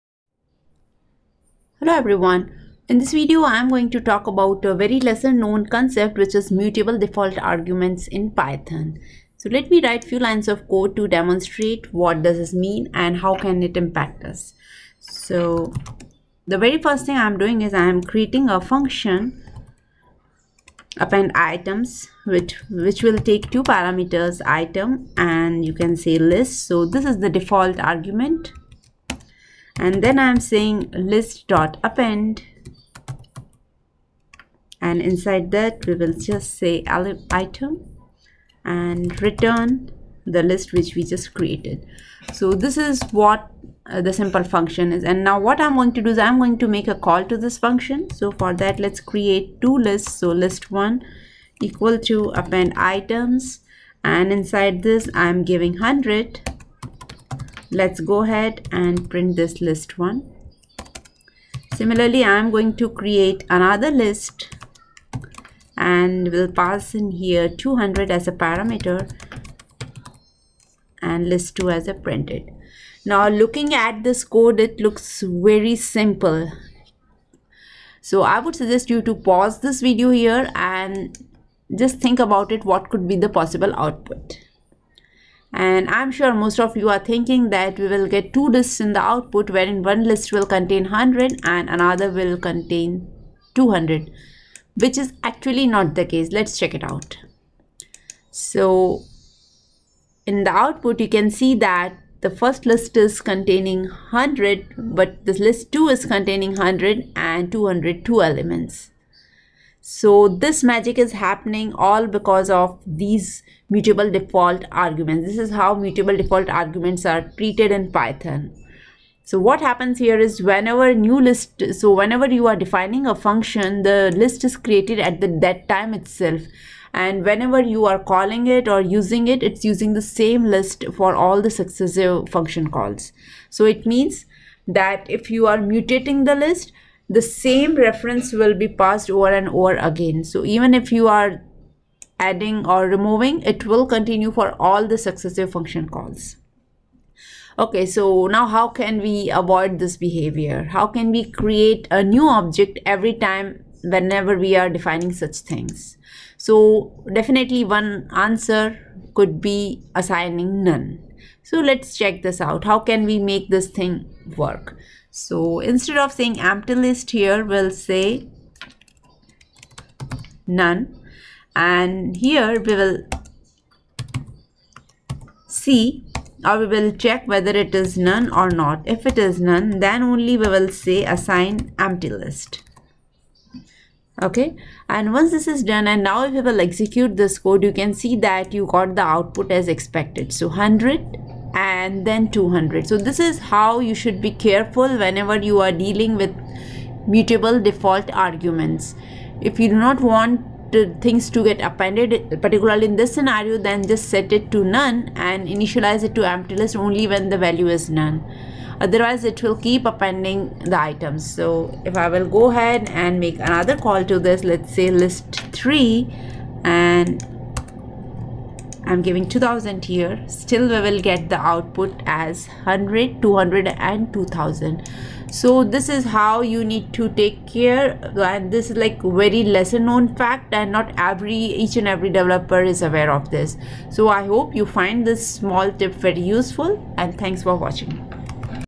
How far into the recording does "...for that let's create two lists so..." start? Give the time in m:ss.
0:48.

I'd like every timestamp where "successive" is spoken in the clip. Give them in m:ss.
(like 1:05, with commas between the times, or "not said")
2:11, 2:24.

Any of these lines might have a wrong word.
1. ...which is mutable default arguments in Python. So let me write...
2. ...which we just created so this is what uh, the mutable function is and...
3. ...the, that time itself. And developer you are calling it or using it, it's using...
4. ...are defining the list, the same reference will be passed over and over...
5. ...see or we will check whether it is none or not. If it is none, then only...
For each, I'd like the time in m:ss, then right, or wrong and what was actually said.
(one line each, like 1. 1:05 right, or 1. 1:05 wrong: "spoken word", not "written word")
1. 0:06 right
2. 0:40 wrong: "simple", not "mutable"
3. 2:05 wrong: "whenever", not "developer"
4. 2:15 wrong: "mutating", not "defining"
5. 2:55 right.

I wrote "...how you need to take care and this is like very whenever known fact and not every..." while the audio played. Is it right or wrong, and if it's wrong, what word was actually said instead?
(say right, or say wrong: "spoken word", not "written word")
wrong: "lesser", not "whenever".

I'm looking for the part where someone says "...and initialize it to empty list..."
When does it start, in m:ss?
3:25.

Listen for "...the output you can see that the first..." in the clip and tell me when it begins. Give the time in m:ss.
1:40.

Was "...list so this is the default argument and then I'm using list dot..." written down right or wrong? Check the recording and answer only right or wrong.
wrong.